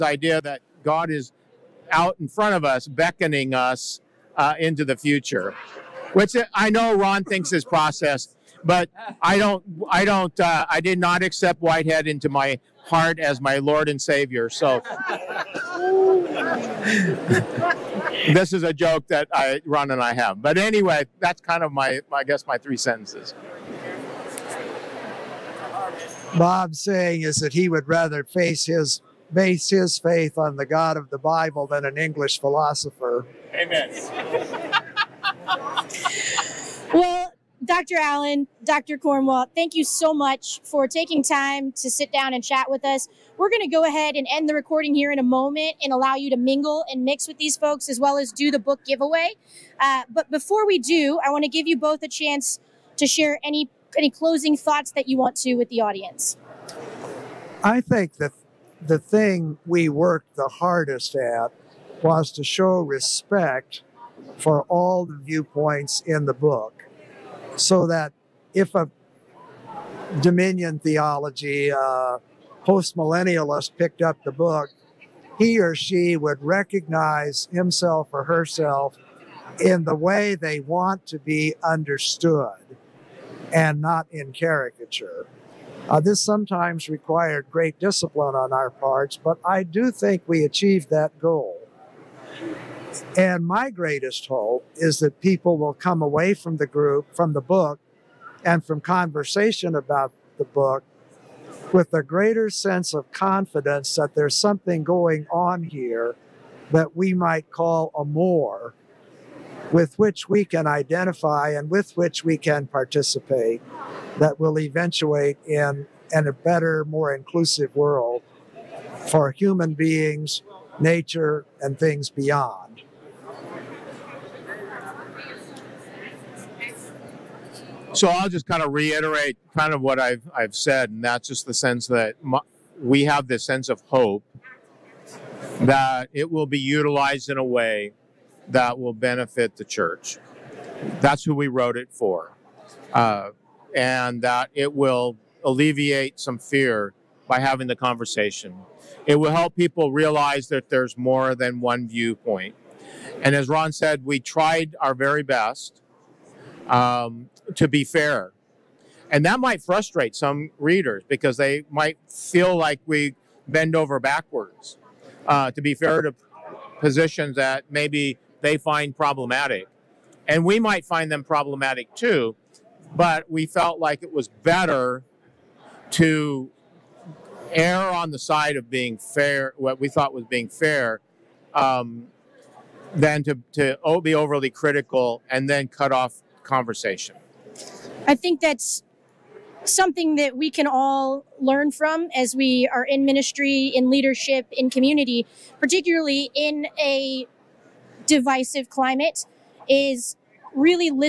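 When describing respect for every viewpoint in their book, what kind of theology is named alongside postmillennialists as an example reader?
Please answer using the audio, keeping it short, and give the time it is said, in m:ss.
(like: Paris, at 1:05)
Dominion theology, at 1:10.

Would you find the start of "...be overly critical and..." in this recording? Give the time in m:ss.
3:04.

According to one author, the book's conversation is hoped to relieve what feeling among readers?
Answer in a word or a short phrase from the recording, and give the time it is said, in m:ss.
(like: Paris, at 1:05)
Fear, at 2:26.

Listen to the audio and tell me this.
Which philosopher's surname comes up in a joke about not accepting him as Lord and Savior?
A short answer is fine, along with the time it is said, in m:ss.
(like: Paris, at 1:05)
Whitehead, at 0:11.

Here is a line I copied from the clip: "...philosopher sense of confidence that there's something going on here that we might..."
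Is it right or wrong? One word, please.
wrong.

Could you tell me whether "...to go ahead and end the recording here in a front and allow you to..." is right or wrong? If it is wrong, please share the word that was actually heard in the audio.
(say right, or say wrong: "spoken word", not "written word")
wrong: "moment", not "front".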